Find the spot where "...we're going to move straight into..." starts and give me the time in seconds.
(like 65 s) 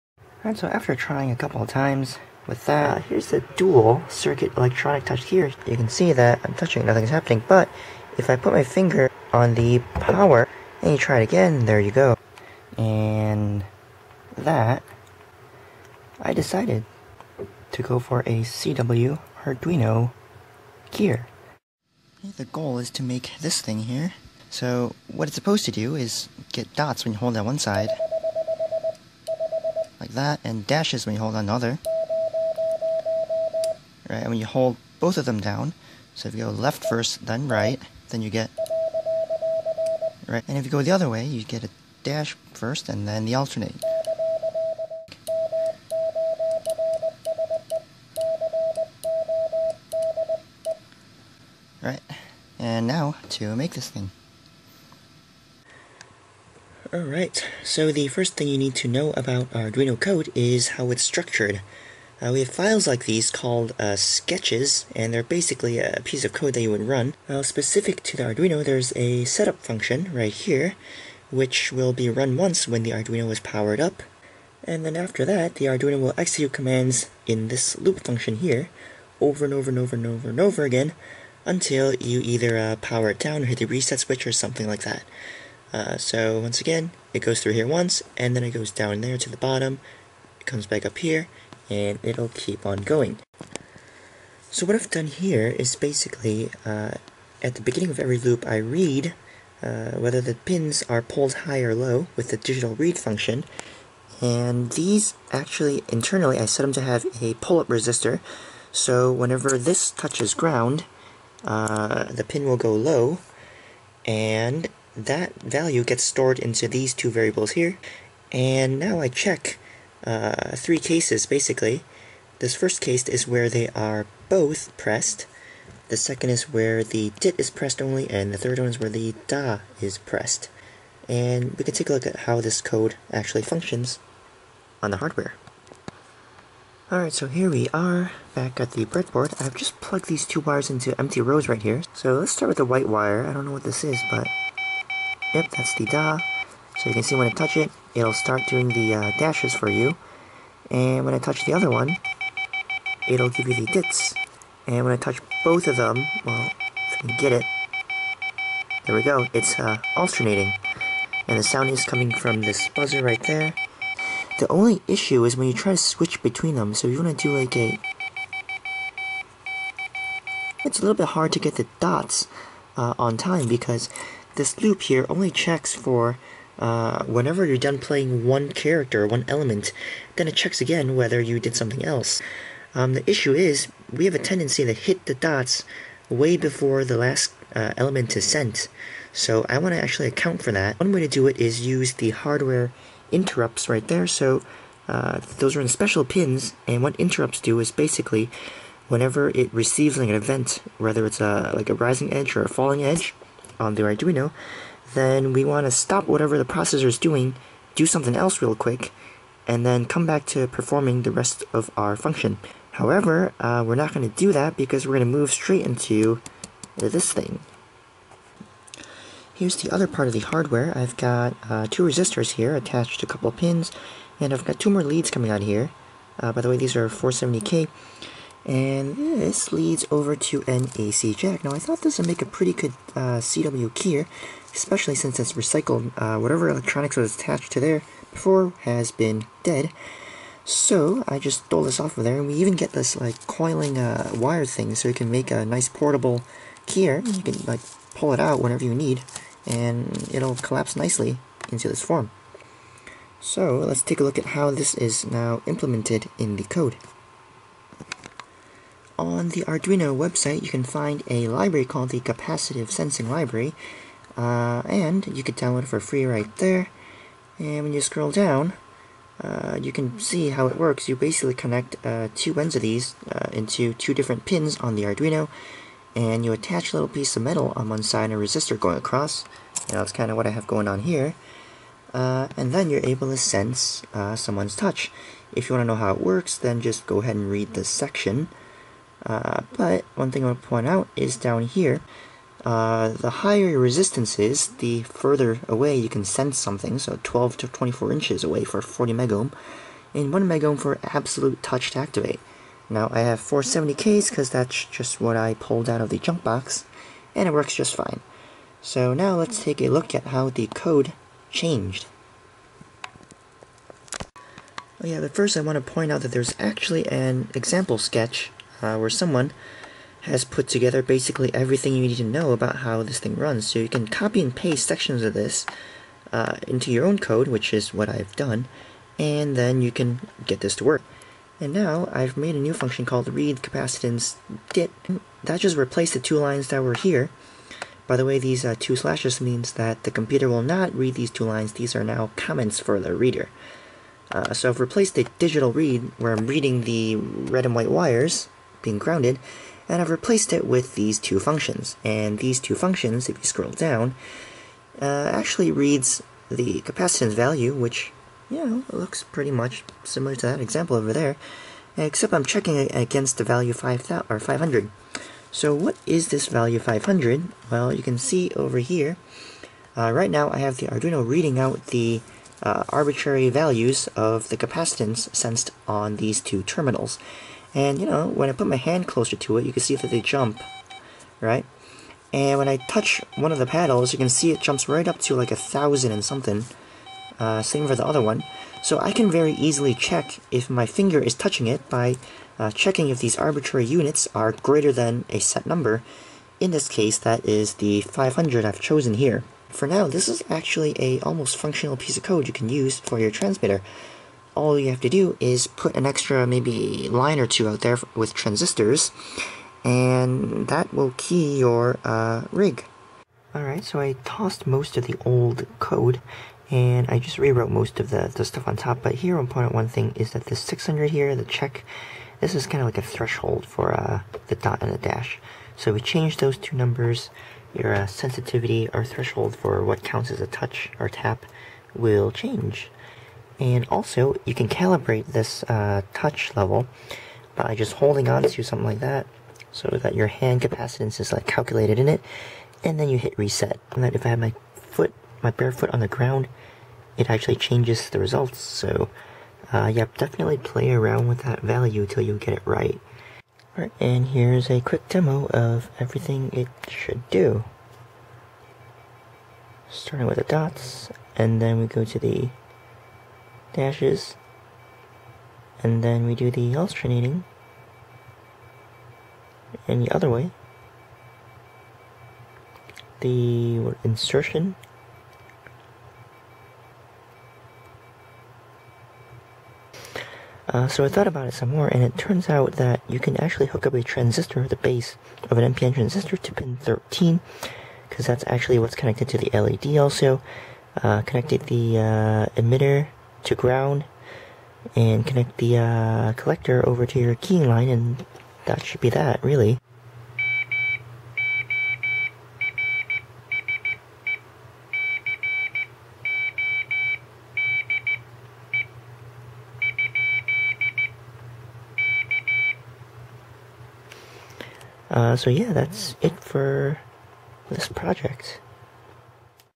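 214 s.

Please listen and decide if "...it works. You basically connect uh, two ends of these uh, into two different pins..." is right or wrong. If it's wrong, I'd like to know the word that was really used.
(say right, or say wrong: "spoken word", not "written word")
right.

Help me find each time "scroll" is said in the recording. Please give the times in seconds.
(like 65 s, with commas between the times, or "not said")
267 s, 353 s.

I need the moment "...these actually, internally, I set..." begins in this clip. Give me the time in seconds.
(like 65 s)
104 s.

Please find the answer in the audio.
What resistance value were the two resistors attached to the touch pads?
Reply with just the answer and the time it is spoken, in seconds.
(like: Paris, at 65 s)
470K, at 226 s.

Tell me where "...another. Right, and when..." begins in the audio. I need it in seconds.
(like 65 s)
31 s.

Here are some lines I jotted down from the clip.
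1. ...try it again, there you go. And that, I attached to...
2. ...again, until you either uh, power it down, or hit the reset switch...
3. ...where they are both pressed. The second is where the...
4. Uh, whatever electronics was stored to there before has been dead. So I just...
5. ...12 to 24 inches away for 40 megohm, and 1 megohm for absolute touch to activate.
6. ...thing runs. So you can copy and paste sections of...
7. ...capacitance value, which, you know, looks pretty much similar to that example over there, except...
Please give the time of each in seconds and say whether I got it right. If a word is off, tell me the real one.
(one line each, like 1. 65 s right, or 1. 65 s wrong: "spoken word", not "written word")
1. 10 s wrong: "decided", not "attached"
2. 80 s right
3. 123 s right
4. 235 s wrong: "attached", not "stored"
5. 297 s right
6. 322 s right
7. 356 s right.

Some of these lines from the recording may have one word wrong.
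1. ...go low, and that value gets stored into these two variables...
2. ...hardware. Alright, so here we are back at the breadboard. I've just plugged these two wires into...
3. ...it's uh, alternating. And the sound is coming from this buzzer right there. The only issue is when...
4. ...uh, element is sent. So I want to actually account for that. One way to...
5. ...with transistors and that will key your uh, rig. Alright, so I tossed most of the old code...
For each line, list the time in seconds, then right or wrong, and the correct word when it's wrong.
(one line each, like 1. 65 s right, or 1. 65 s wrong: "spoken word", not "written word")
1. 112 s right
2. 134 s right
3. 159 s right
4. 187 s right
5. 407 s right.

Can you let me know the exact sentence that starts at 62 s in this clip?
Uh, we have files like these called uh, sketches, and they're basically a piece of code that you would run.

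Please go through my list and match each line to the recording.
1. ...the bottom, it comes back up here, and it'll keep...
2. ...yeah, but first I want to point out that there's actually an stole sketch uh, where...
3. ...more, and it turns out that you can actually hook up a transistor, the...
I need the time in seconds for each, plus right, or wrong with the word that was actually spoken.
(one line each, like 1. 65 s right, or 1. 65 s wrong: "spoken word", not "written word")
1. 89 s right
2. 314 s wrong: "example", not "stole"
3. 481 s right.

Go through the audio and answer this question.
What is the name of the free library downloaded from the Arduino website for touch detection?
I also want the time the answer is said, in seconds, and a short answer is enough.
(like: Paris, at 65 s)
Capacitive Sensing Library, at 261 s.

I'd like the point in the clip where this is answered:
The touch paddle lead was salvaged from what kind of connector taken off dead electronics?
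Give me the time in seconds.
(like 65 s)
230 s.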